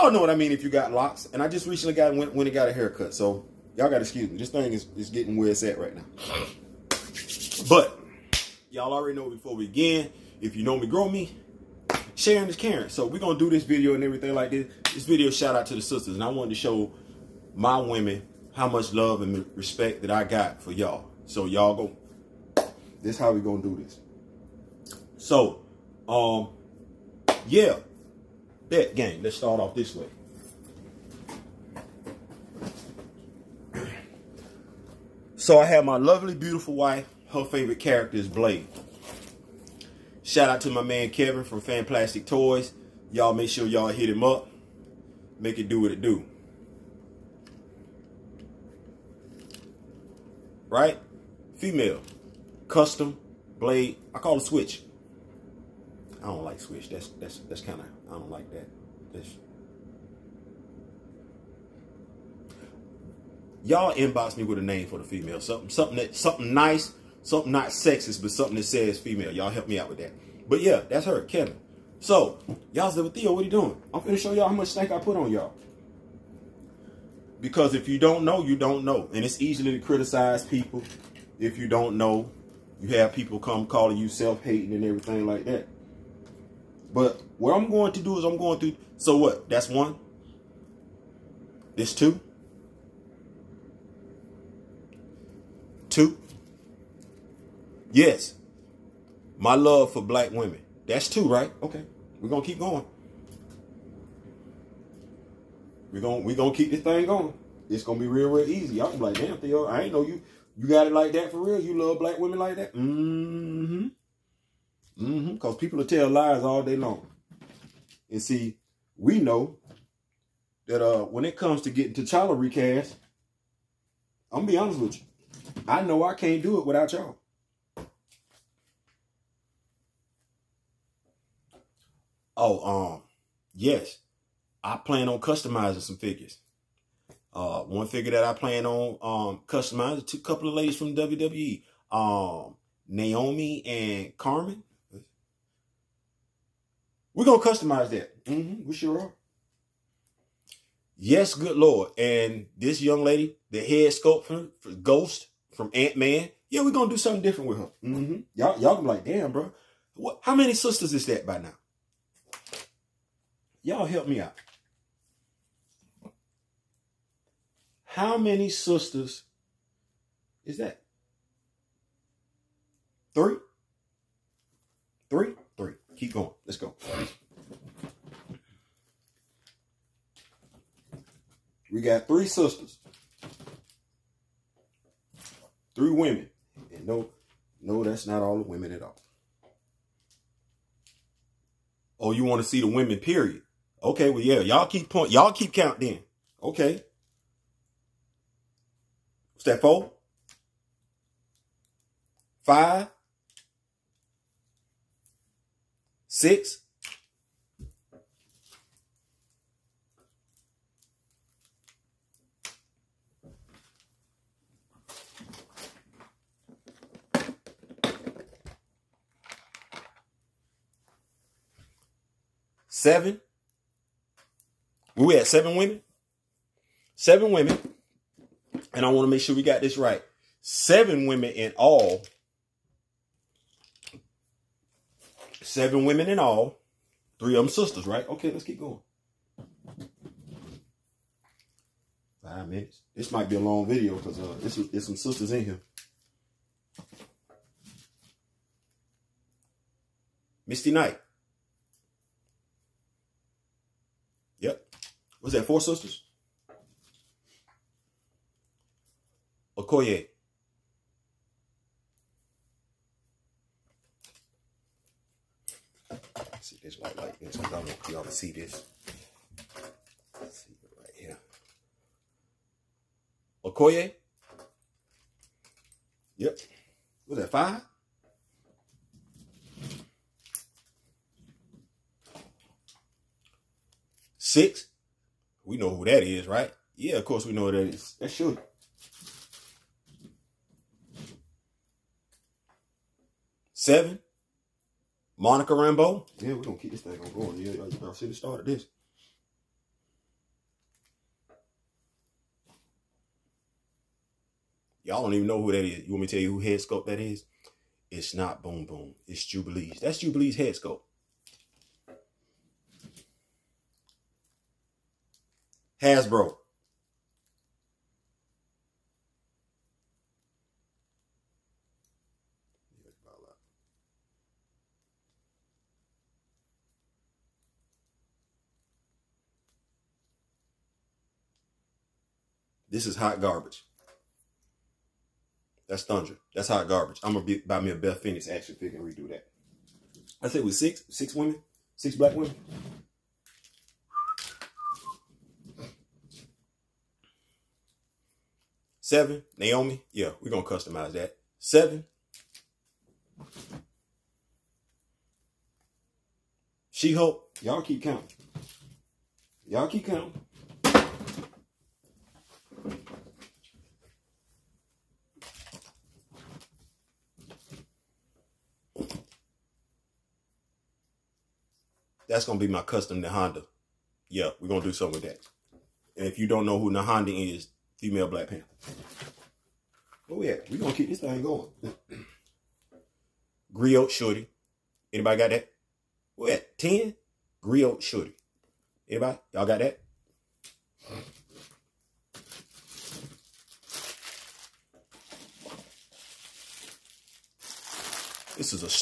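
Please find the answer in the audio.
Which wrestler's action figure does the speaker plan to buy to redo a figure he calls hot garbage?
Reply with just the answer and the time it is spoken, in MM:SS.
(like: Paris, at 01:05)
Beth Phoenix, at 05:37.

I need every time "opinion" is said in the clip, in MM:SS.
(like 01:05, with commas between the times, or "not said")
not said.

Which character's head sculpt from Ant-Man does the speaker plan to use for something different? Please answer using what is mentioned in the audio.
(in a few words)
Ghost.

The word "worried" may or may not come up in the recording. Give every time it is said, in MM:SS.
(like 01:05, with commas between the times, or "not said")
not said.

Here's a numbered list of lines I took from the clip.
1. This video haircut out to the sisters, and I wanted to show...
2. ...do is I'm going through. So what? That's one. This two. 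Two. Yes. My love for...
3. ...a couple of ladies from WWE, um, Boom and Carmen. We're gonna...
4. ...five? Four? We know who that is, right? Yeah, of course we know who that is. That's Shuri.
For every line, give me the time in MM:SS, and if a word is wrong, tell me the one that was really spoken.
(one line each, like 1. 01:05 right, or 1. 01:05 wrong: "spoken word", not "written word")
1. 00:14 wrong: "shout", not "haircut"
2. 01:28 right
3. 02:20 wrong: "Naomi", not "Boom"
4. 04:37 wrong: "Six", not "Four".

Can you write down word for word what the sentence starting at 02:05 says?
I know I can't do it without y'all.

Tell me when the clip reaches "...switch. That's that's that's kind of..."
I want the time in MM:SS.
00:56.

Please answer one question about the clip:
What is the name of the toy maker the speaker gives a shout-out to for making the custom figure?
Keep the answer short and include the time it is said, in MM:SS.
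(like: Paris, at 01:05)
Fan Plastic Toys, at 00:41.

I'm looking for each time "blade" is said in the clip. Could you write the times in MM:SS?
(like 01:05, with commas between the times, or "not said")
00:38, 00:53.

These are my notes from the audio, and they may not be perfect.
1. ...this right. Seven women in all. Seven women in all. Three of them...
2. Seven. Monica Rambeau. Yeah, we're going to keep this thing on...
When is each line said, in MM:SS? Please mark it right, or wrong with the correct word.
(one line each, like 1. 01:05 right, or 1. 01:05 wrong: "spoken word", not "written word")
1. 03:49 right
2. 04:53 right.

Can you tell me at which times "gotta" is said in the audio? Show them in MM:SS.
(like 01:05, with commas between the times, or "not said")
00:03.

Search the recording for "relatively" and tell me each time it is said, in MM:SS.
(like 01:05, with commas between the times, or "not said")
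not said.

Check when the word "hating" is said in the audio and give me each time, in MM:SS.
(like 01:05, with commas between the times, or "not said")
01:24.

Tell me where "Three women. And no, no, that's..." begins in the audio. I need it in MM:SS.
03:05.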